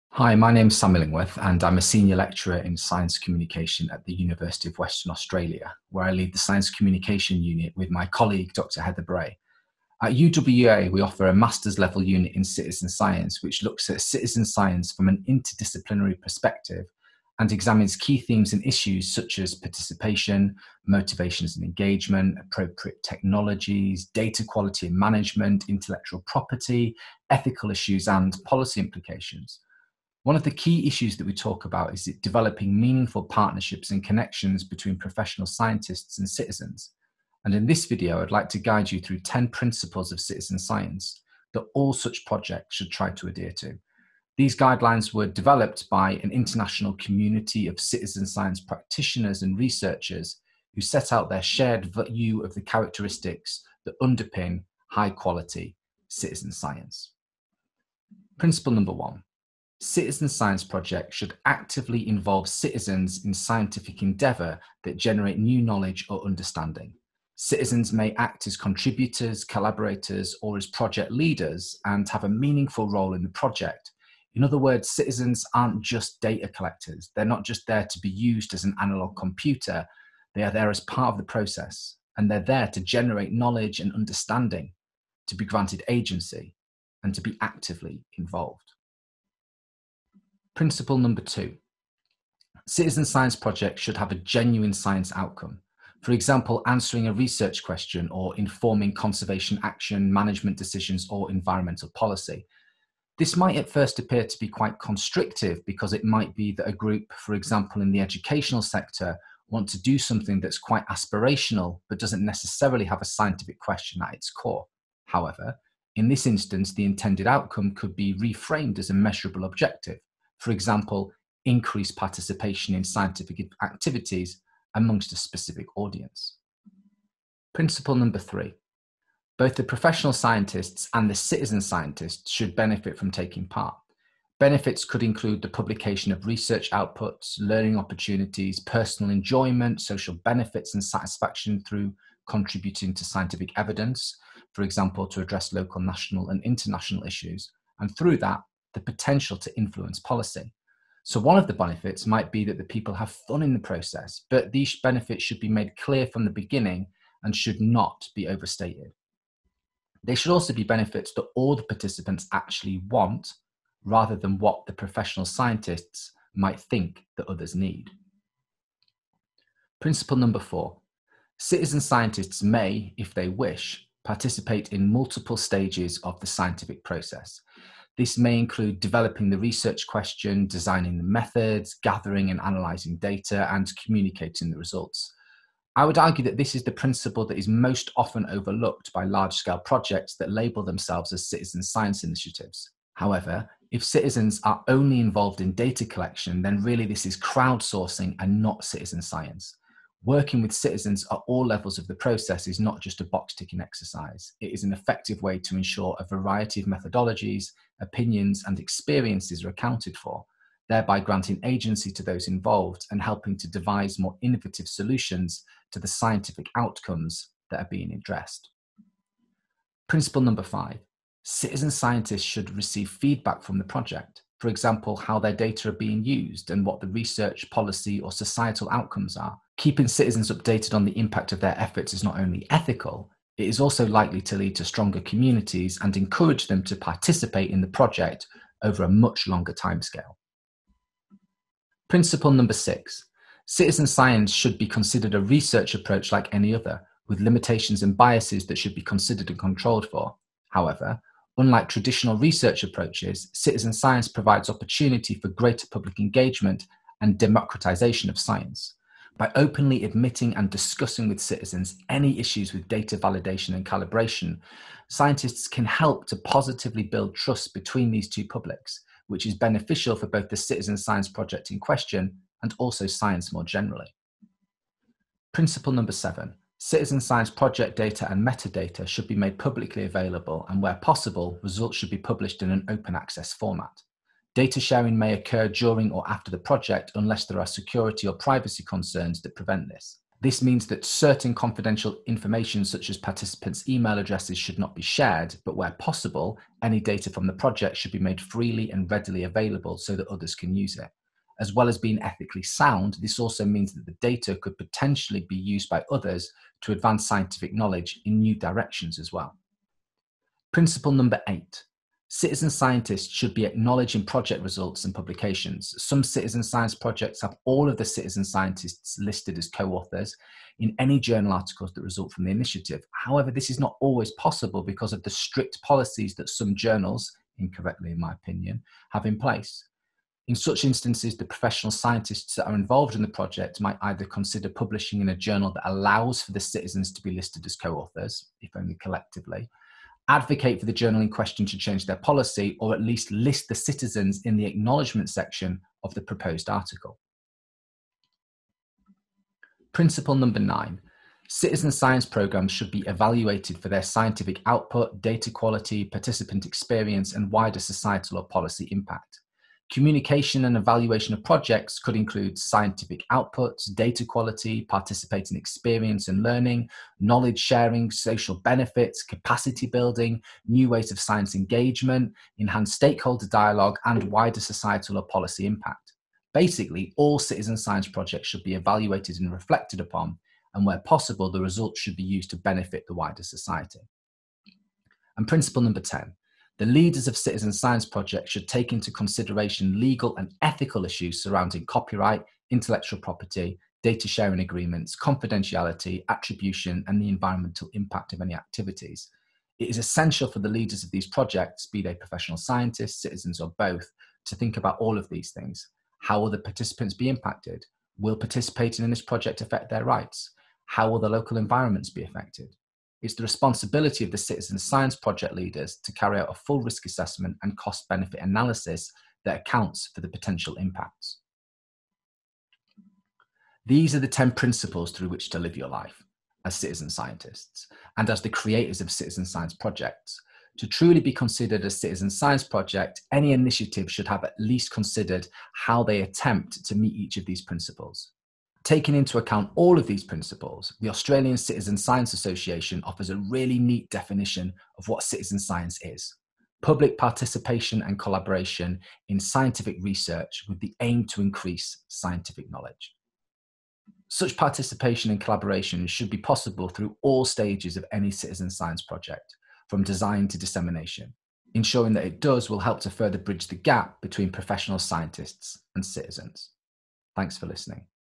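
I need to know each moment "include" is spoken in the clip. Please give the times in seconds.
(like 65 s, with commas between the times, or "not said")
135 s, 178 s, 361 s.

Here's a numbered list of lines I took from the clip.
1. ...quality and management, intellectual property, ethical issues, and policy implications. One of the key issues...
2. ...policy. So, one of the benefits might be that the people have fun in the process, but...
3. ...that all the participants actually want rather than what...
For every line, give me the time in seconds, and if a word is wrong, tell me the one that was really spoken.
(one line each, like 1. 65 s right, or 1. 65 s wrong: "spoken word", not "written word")
1. 24 s right
2. 149 s right
3. 161 s right.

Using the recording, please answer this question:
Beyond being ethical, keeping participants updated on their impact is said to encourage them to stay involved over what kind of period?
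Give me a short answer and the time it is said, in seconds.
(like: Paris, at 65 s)
a much longer timescale, at 238 s.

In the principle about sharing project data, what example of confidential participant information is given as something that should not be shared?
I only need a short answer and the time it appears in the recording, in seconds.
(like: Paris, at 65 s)
email addresses, at 293 s.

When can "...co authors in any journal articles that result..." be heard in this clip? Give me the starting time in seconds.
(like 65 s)
319 s.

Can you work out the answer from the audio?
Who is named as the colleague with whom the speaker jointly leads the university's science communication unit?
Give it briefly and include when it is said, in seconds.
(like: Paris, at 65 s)
Dr. Heather Bray, at 8 s.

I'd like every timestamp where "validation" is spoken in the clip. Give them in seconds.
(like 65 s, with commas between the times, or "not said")
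262 s.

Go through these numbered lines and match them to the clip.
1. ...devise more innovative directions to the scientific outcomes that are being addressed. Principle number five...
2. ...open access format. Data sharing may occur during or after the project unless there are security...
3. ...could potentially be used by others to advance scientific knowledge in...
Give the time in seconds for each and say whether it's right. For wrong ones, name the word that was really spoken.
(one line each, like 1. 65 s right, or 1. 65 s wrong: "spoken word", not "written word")
1. 213 s wrong: "solutions", not "directions"
2. 282 s right
3. 304 s right.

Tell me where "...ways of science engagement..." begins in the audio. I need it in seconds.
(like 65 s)
370 s.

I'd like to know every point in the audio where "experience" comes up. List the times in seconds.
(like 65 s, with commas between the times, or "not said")
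208 s, 356 s, 365 s.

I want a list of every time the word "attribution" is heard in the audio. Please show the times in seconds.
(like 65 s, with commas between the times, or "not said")
396 s.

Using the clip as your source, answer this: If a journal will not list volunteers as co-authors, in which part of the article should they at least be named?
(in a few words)
acknowledgement section.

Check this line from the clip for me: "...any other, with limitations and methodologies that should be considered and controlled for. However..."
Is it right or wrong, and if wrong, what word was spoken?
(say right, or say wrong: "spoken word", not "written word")
wrong: "biases", not "methodologies".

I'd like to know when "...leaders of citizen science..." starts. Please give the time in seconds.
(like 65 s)
386 s.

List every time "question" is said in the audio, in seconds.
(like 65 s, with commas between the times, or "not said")
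97 s, 113 s, 179 s, 271 s, 341 s.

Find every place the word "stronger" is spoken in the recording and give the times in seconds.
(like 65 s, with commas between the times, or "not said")
234 s.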